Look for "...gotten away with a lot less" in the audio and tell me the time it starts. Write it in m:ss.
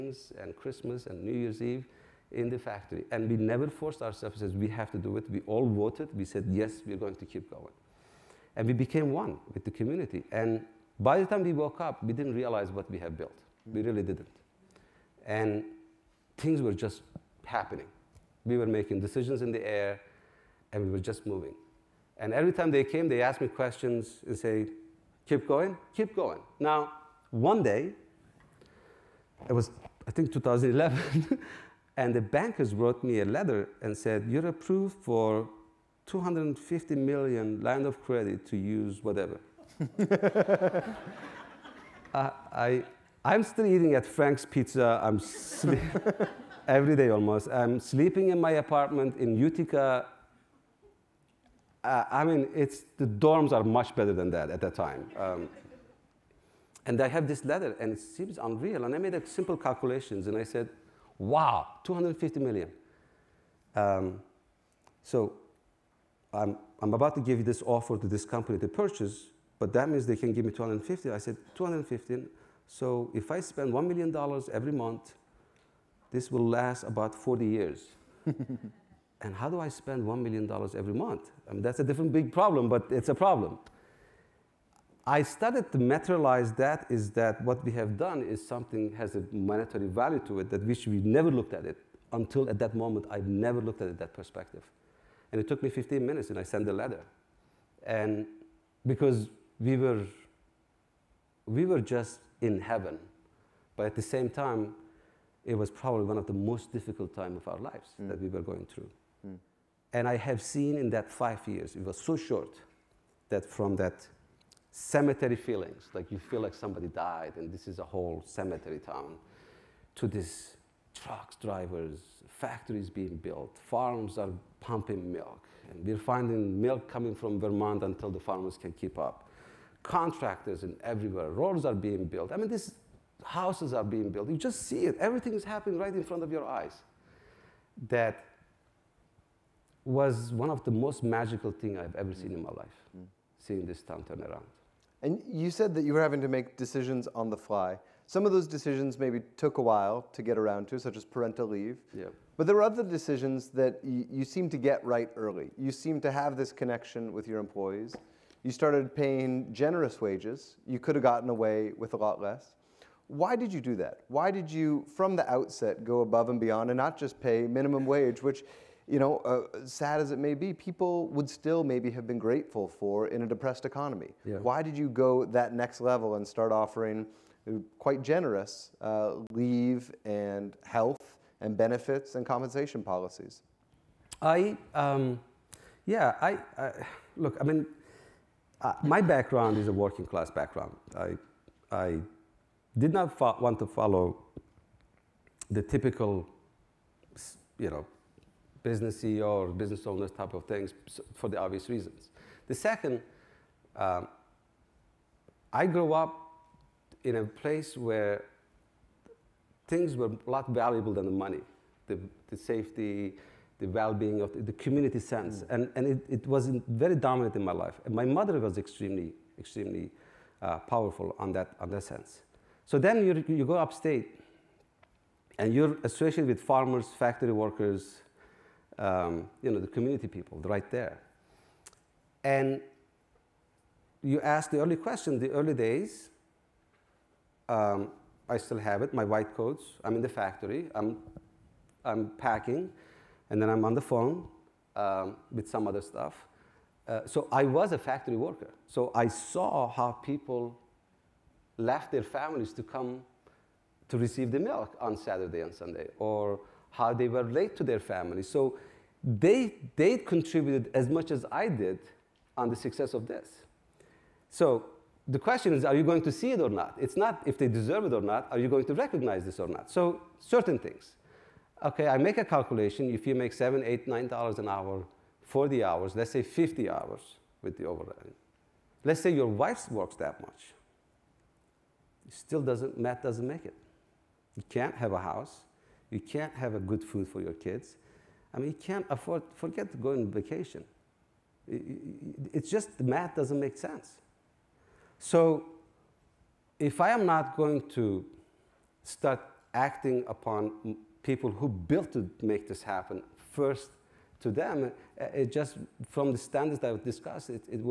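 2:41.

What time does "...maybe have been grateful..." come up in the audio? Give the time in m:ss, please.
2:51.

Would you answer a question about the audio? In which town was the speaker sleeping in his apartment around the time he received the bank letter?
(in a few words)
Utica.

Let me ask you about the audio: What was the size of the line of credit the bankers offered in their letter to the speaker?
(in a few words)
250 million.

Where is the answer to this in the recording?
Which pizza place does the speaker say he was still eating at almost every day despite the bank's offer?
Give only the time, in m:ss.
0:44.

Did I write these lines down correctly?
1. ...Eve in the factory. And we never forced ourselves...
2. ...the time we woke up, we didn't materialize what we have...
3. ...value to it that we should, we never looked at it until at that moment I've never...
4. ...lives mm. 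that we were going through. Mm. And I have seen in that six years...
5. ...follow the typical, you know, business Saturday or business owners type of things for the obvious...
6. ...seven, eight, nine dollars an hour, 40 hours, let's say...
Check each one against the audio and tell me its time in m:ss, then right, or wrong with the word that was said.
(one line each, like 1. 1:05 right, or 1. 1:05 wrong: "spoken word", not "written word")
1. 0:01 right
2. 0:11 wrong: "realize", not "materialize"
3. 1:29 right
4. 1:47 wrong: "five", not "six"
5. 3:13 wrong: "CEO", not "Saturday"
6. 4:33 right.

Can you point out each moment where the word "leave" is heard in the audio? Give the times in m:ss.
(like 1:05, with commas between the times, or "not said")
2:31, 2:59.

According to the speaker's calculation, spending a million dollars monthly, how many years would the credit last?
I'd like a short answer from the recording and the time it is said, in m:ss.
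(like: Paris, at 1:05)
40 years, at 1:16.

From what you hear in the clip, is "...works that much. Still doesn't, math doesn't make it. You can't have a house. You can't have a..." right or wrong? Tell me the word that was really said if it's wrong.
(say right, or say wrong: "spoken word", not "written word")
right.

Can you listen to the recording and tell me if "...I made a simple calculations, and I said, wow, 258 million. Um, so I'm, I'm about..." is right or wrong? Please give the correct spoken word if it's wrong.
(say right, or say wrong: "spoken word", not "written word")
wrong: "250", not "258".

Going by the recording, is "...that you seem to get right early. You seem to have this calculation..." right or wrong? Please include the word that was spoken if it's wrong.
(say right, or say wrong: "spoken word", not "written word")
wrong: "connection", not "calculation".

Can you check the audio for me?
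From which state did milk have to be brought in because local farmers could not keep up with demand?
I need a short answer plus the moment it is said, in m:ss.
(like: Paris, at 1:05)
Vermont, at 2:07.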